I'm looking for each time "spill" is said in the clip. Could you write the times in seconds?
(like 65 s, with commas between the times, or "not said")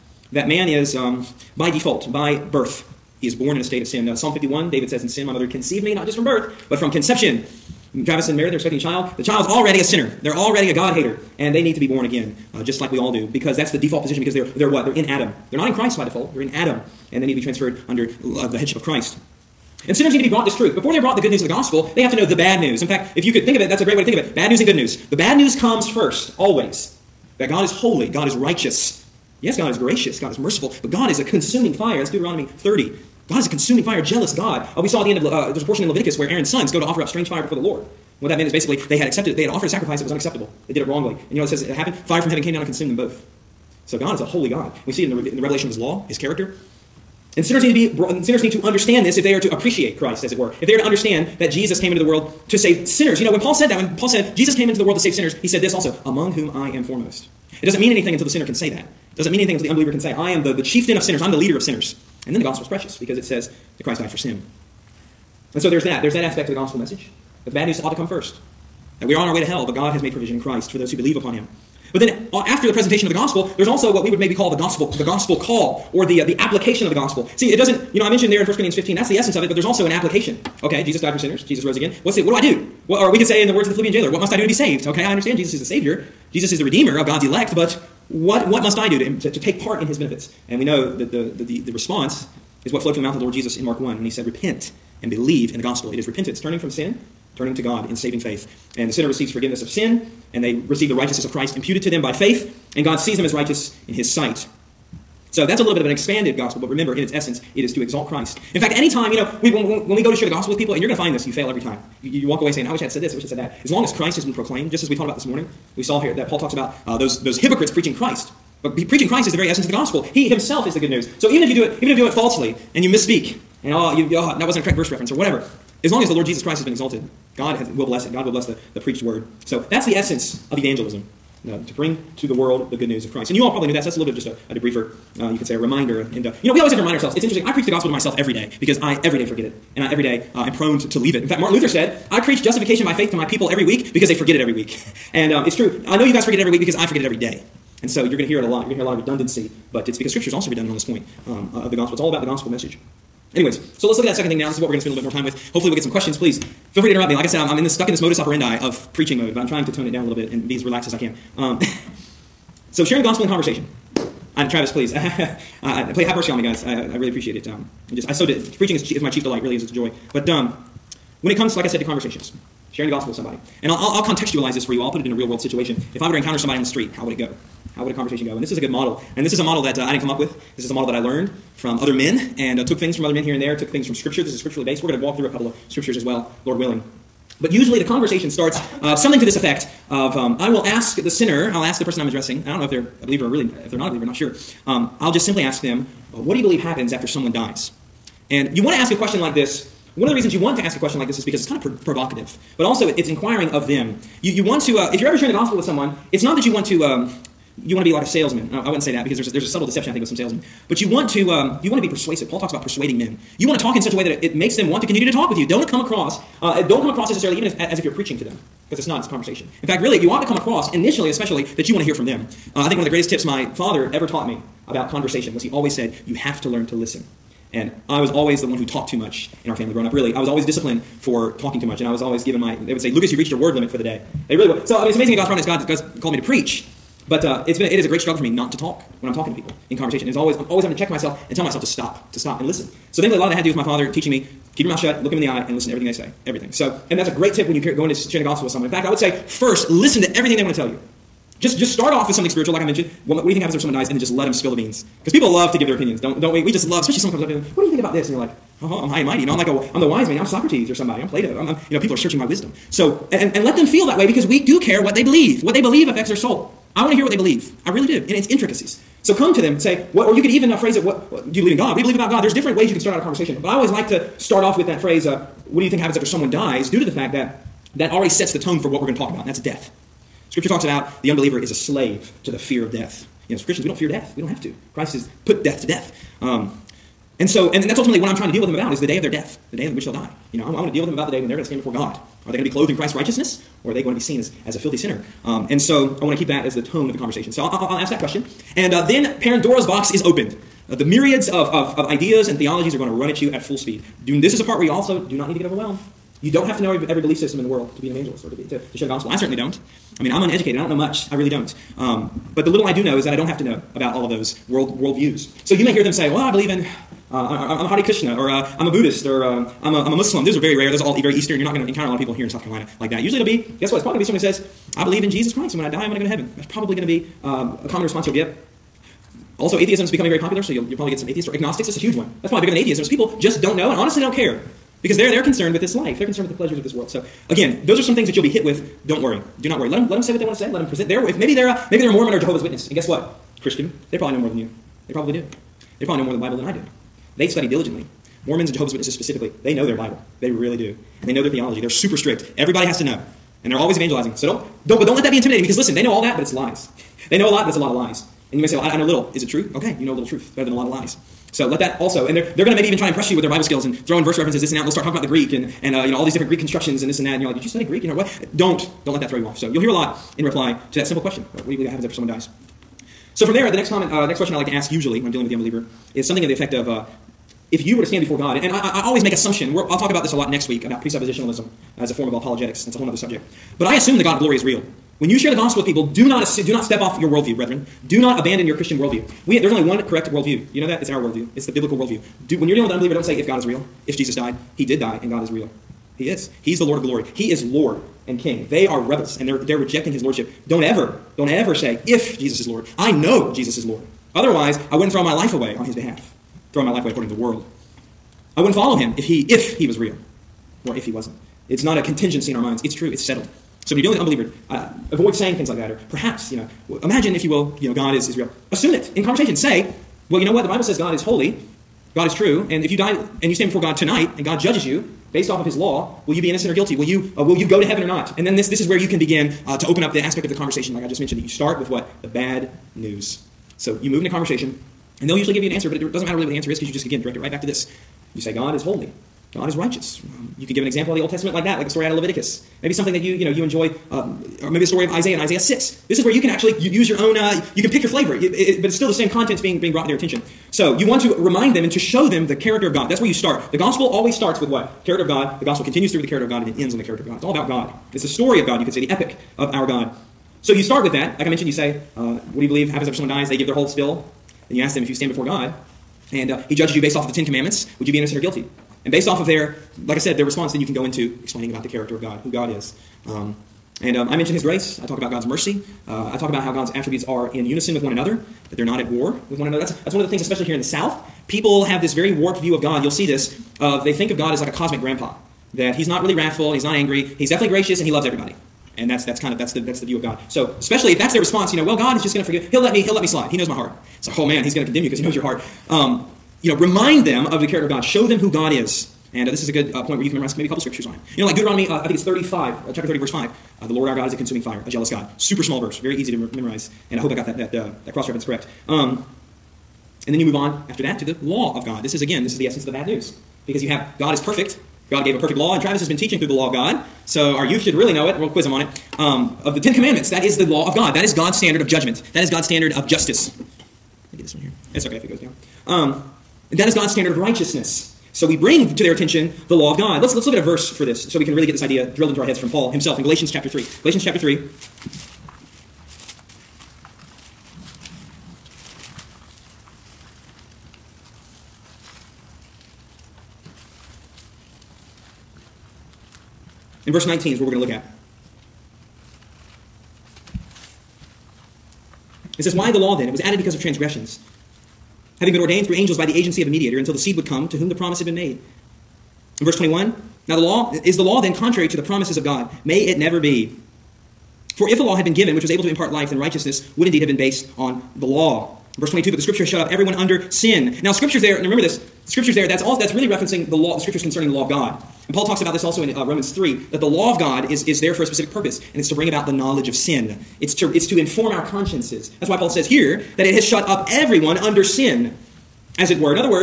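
254 s, 463 s.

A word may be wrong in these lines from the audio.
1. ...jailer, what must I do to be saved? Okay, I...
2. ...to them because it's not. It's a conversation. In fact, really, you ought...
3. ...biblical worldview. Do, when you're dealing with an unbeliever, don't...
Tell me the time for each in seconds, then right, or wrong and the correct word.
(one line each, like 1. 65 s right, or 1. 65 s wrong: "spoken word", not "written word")
1. 83 s right
2. 218 s right
3. 391 s right.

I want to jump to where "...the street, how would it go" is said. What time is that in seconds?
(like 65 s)
176 s.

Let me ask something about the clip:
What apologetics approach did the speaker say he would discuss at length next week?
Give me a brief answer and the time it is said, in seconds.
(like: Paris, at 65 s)
Presuppositionalism, at 380 s.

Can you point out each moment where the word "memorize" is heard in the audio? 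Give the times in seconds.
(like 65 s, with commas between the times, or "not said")
500 s, 506 s.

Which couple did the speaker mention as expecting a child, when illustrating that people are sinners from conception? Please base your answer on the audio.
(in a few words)
Travis and Meredith.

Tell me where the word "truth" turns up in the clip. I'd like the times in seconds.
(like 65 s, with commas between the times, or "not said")
20 s, 360 s.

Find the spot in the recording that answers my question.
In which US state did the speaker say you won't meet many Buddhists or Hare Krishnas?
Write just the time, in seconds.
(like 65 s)
322 s.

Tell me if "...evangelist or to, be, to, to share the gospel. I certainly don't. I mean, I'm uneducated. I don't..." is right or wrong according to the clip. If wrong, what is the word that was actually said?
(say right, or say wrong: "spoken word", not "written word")
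right.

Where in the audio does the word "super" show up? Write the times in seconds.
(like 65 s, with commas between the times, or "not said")
351 s, 505 s.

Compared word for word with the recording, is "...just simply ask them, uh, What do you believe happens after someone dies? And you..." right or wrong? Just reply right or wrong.
right.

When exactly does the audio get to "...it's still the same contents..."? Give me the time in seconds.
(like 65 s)
448 s.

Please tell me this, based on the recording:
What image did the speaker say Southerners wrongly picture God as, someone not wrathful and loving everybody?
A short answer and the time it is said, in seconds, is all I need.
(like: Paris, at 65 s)
A cosmic grandpa, at 484 s.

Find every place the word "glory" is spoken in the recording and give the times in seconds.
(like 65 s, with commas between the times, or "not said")
384 s, 396 s.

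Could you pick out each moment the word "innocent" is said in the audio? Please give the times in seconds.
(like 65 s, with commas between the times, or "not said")
426 s, 467 s.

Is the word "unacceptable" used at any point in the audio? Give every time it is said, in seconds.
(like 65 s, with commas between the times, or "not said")
40 s.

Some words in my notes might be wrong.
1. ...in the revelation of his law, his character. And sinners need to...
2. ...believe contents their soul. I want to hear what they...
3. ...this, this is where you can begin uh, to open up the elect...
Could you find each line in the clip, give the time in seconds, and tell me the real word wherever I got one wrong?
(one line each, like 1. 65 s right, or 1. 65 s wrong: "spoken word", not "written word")
1. 45 s right
2. 265 s wrong: "affects", not "contents"
3. 428 s wrong: "aspect", not "elect".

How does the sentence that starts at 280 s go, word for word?
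Scripture talks about the unbeliever is a slave to the fear of death.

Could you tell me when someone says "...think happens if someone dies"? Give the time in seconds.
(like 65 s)
253 s.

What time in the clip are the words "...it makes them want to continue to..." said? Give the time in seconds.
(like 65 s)
214 s.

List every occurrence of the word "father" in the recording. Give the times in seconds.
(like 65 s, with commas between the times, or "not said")
223 s, 243 s.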